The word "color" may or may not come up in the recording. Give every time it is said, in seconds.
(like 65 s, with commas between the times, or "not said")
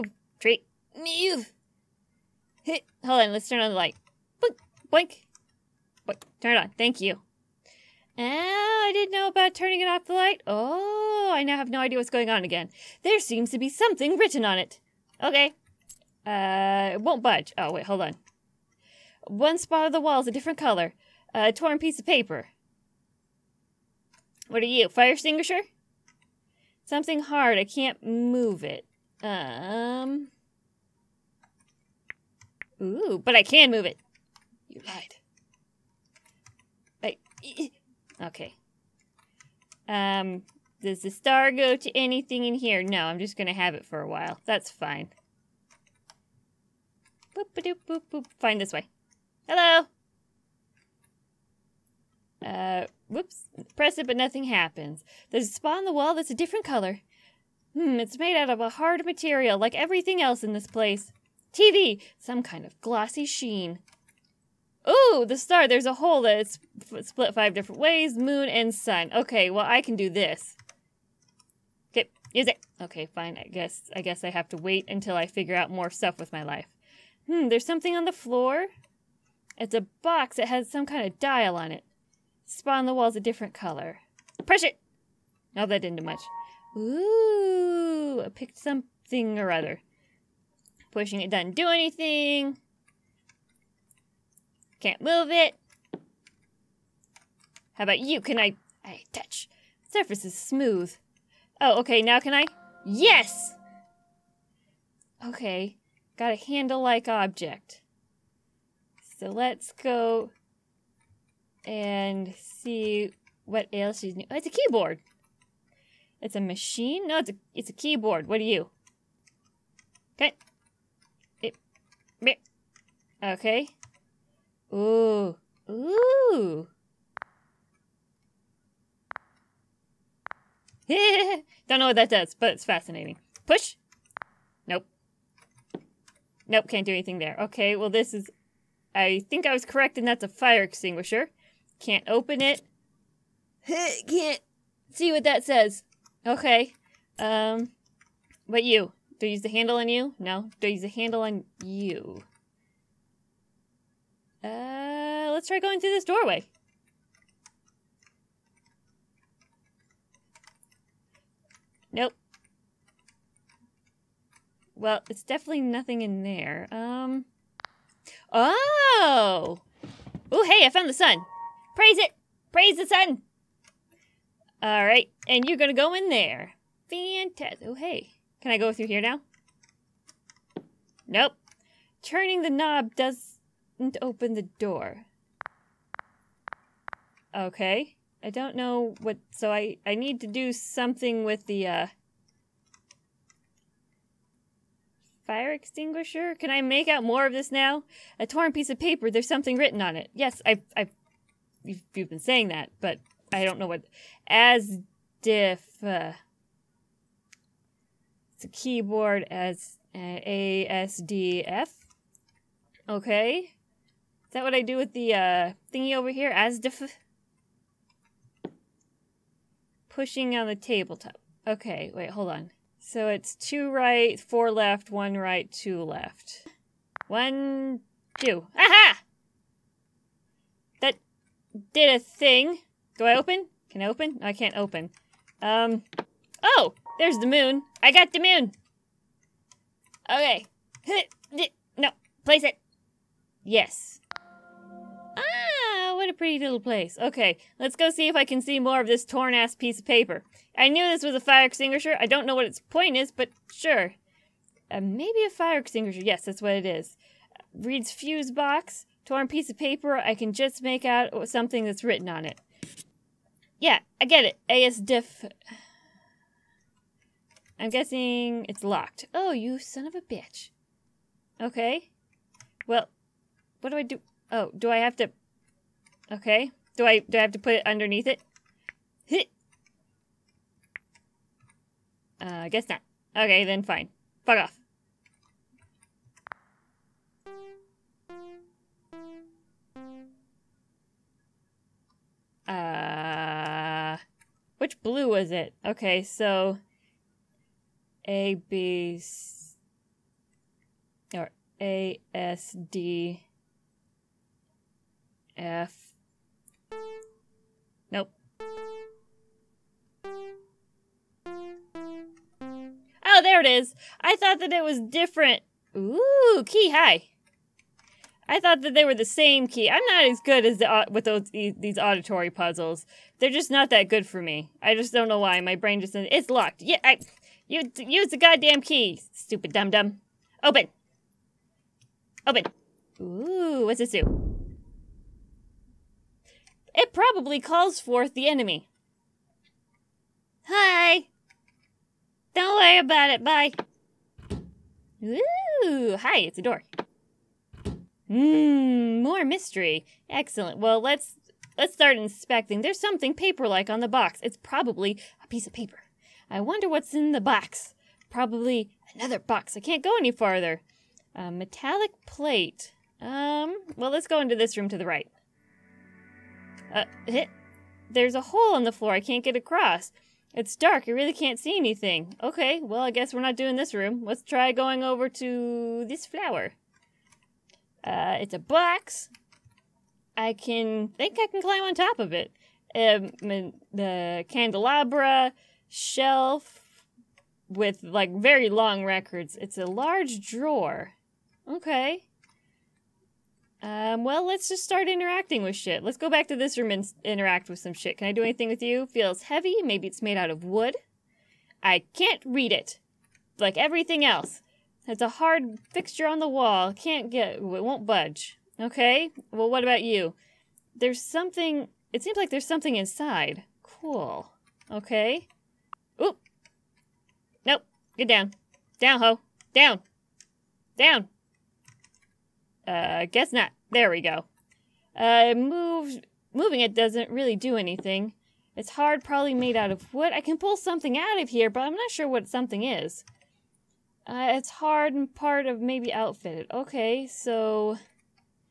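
20 s, 56 s, 83 s.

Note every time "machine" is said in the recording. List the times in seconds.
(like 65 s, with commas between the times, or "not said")
116 s.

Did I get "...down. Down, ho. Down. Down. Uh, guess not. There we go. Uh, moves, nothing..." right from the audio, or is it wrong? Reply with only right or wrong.
wrong.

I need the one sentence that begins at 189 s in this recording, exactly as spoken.
So I, I need to do something with the, uh...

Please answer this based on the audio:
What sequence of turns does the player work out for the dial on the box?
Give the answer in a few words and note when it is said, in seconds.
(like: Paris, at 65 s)
Two right, four left, one right, two left, at 223 s.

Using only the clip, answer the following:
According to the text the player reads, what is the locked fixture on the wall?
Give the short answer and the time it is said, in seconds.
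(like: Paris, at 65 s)
Fuse box, at 257 s.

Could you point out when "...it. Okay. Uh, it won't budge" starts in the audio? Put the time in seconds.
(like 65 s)
14 s.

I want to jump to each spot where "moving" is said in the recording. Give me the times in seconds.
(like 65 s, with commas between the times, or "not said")
426 s.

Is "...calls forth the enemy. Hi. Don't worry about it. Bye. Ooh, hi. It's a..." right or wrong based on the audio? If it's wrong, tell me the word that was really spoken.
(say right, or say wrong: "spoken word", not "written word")
right.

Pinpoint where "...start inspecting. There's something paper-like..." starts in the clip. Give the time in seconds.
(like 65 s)
351 s.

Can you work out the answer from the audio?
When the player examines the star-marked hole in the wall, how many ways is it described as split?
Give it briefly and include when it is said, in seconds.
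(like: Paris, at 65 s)
5, at 67 s.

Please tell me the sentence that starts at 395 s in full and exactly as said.
Let's go back to this room and interact with some shit.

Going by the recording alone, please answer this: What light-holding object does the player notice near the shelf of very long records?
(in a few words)
Candelabra.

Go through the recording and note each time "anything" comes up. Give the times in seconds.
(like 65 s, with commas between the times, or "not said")
41 s, 91 s, 136 s, 371 s, 398 s, 427 s.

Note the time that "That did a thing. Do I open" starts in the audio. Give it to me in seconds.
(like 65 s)
230 s.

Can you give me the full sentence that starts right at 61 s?
TV, some kind of glossy sheen.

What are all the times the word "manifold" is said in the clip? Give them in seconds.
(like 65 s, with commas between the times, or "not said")
not said.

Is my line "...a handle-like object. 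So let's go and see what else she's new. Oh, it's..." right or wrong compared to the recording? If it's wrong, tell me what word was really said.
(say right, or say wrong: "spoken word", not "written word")
right.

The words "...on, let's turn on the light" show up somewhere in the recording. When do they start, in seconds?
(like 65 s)
3 s.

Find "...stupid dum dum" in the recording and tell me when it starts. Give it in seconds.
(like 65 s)
329 s.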